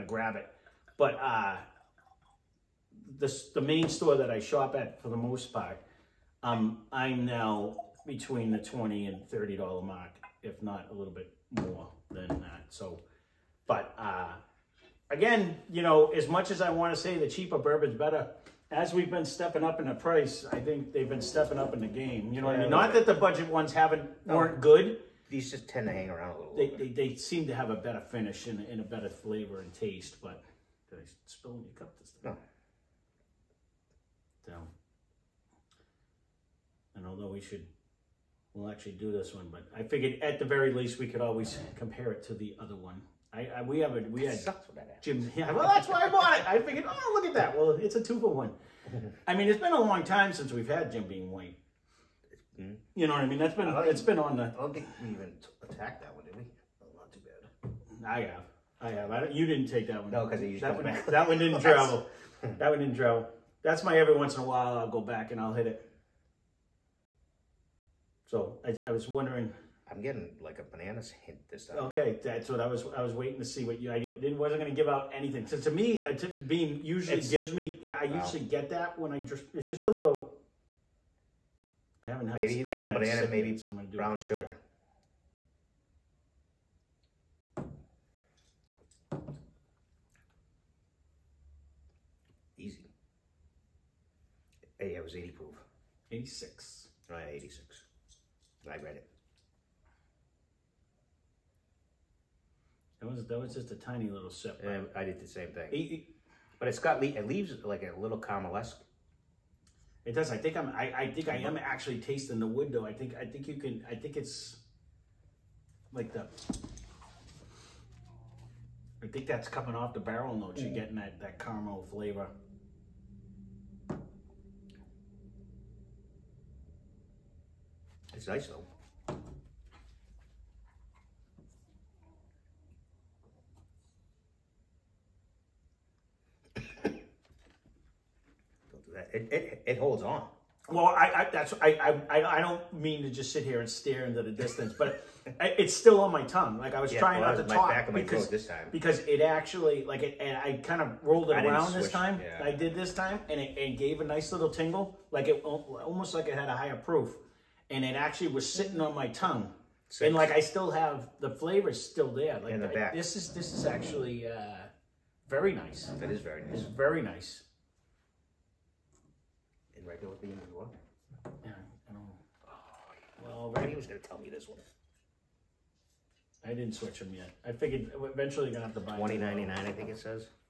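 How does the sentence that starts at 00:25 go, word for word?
These just tend to hang around a little.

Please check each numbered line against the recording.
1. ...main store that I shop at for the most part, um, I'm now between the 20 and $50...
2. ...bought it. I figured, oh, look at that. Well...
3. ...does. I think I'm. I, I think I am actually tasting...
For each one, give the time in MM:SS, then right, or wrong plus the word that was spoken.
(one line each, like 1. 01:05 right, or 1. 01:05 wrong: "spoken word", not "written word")
1. 00:03 wrong: "30", not "50"
2. 00:46 right
3. 01:50 right.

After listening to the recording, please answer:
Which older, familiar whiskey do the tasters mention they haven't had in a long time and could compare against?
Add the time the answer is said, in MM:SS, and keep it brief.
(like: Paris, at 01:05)
Jim Beam White, at 00:50.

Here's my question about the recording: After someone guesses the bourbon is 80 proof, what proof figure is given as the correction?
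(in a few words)
86.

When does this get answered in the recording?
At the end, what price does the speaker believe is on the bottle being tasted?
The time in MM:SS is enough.
02:58.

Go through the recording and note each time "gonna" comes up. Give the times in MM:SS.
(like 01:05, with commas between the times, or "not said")
01:14, 01:23, 02:53, 02:58.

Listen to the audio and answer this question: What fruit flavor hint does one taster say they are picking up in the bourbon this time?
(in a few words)
bananas.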